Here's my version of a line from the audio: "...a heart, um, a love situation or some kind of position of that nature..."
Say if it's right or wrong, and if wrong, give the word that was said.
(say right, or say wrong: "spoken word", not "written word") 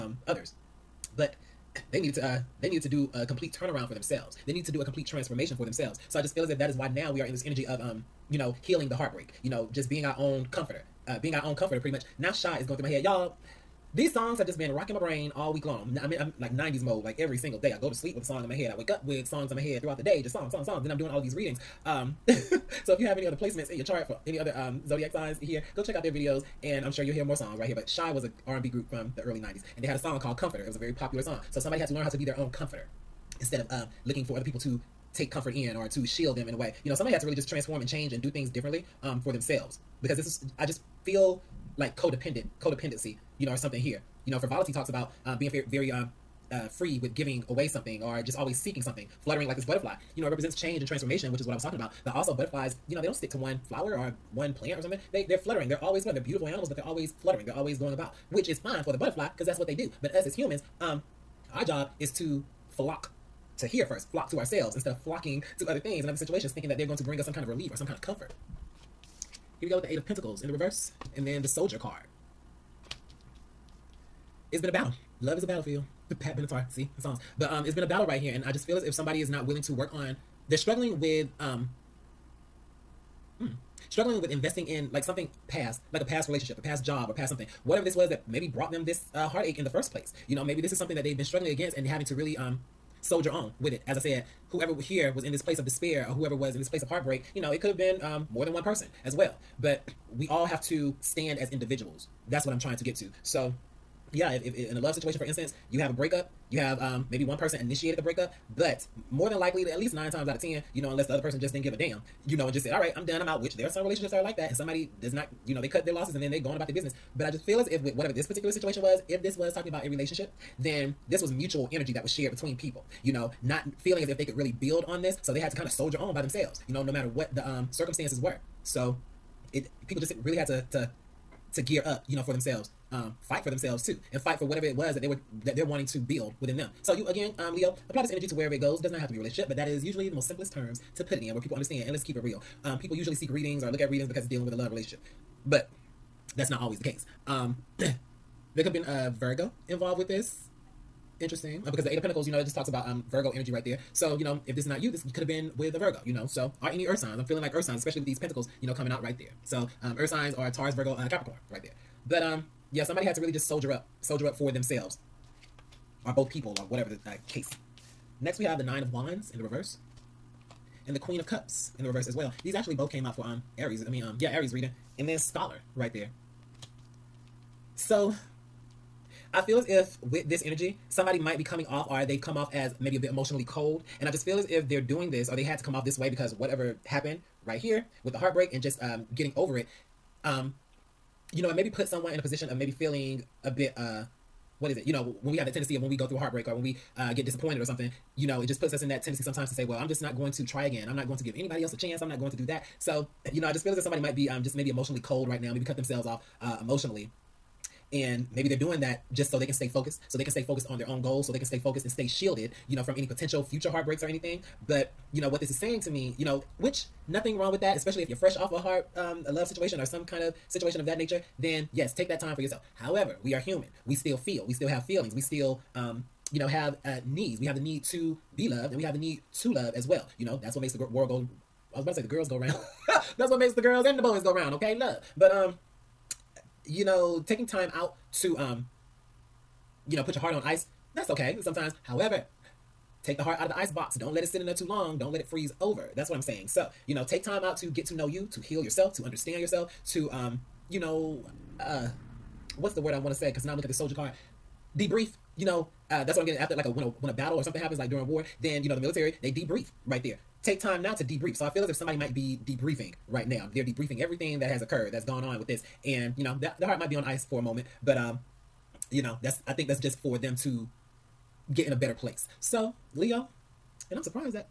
wrong: "situation", not "position".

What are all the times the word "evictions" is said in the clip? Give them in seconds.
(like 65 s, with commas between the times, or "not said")
not said.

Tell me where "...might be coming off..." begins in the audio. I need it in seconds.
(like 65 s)
181 s.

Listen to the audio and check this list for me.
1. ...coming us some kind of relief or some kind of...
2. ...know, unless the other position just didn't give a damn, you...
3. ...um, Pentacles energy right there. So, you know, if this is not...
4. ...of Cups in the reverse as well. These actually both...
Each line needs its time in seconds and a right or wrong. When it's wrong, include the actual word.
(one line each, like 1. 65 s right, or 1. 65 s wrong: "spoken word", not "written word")
1. 67 s wrong: "bring", not "coming"
2. 110 s wrong: "person", not "position"
3. 152 s wrong: "Virgo", not "Pentacles"
4. 171 s right.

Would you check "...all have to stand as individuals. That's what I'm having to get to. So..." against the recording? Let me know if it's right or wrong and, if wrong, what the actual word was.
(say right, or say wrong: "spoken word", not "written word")
wrong: "trying", not "having".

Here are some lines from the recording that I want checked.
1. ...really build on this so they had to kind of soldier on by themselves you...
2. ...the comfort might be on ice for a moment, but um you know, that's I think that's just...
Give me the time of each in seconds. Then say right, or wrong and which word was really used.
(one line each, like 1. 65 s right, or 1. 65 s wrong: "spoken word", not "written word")
1. 124 s right
2. 266 s wrong: "heart", not "comfort".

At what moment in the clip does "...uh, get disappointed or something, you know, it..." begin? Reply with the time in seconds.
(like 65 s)
196 s.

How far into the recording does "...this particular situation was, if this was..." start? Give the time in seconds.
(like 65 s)
118 s.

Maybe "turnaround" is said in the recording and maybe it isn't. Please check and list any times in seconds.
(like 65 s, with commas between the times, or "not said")
3 s.